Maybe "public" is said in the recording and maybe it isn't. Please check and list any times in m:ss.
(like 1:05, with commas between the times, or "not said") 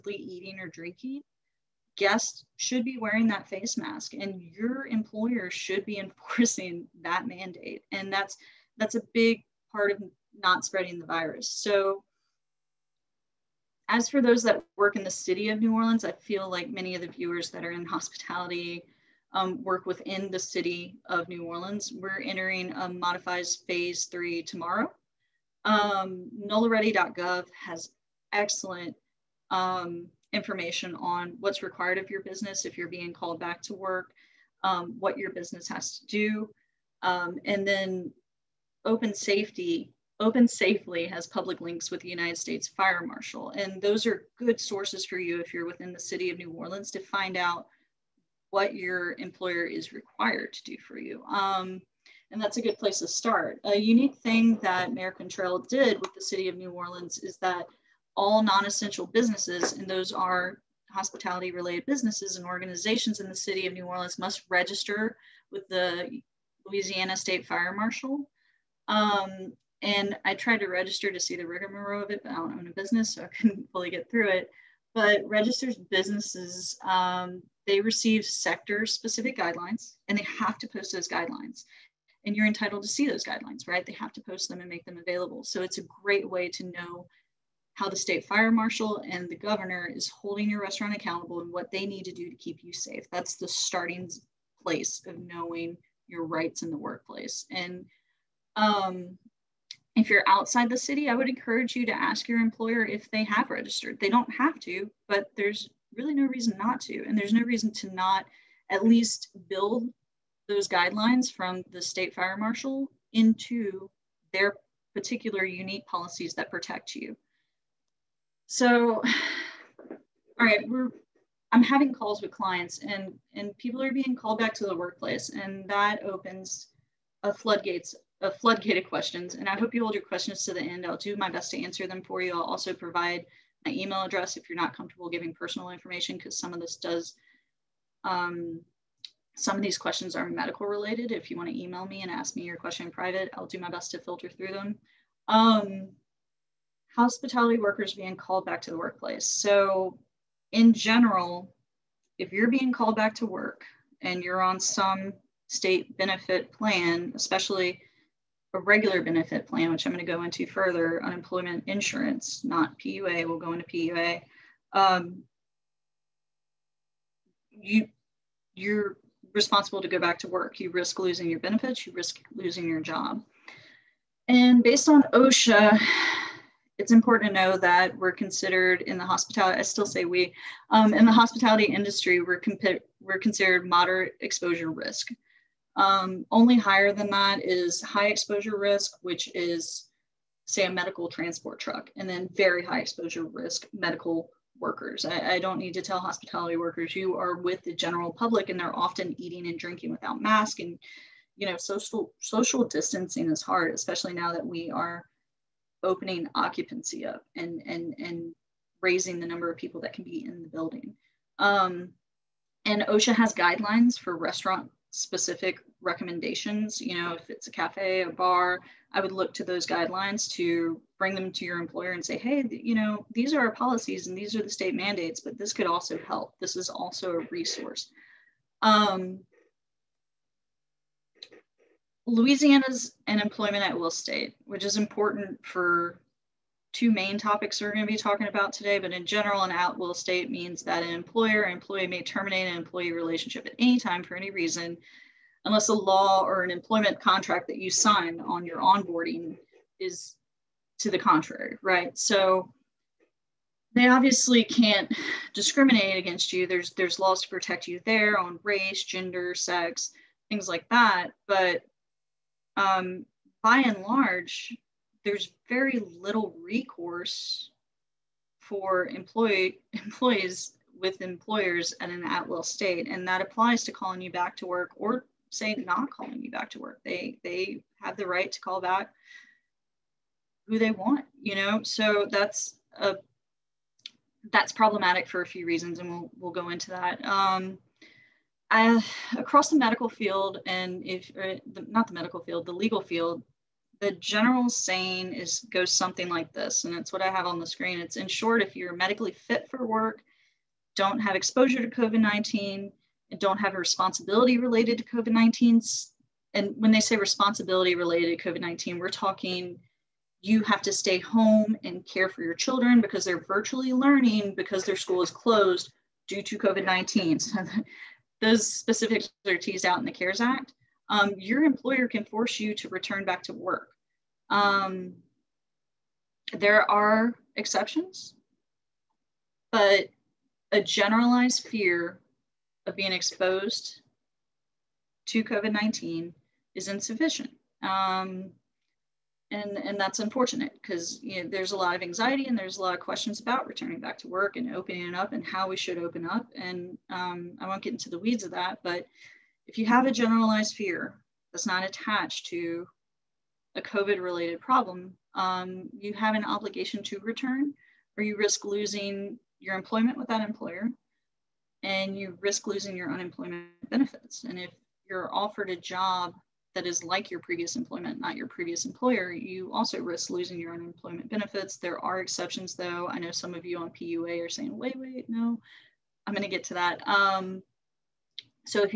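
0:41, 3:18.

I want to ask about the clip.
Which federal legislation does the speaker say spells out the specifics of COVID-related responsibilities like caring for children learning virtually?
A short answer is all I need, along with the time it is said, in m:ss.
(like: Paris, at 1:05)
CARES Act, at 5:19.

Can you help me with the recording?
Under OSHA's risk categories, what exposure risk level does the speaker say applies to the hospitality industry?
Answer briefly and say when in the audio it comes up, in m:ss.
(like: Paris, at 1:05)
Moderate exposure risk, at 3:03.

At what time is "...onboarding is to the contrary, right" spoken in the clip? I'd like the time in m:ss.
4:08.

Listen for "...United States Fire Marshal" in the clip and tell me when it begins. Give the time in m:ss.
0:42.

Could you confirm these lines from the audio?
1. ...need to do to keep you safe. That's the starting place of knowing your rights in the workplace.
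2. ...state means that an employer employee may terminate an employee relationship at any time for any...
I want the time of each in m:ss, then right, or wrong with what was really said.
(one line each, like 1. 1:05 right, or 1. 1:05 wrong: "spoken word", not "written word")
1. 1:31 right
2. 3:59 right.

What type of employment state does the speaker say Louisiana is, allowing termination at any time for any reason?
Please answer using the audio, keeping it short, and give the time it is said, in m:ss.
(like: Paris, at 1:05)
Employment at will, at 3:53.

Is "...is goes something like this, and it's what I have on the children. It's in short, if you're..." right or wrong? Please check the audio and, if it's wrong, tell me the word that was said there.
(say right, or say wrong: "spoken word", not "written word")
wrong: "screen", not "children".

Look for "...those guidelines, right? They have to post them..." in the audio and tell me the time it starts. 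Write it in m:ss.
1:23.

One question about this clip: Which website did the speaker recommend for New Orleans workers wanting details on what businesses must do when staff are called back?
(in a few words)
nolaready.gov.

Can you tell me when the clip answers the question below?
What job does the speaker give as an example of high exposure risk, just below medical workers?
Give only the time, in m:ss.
3:10.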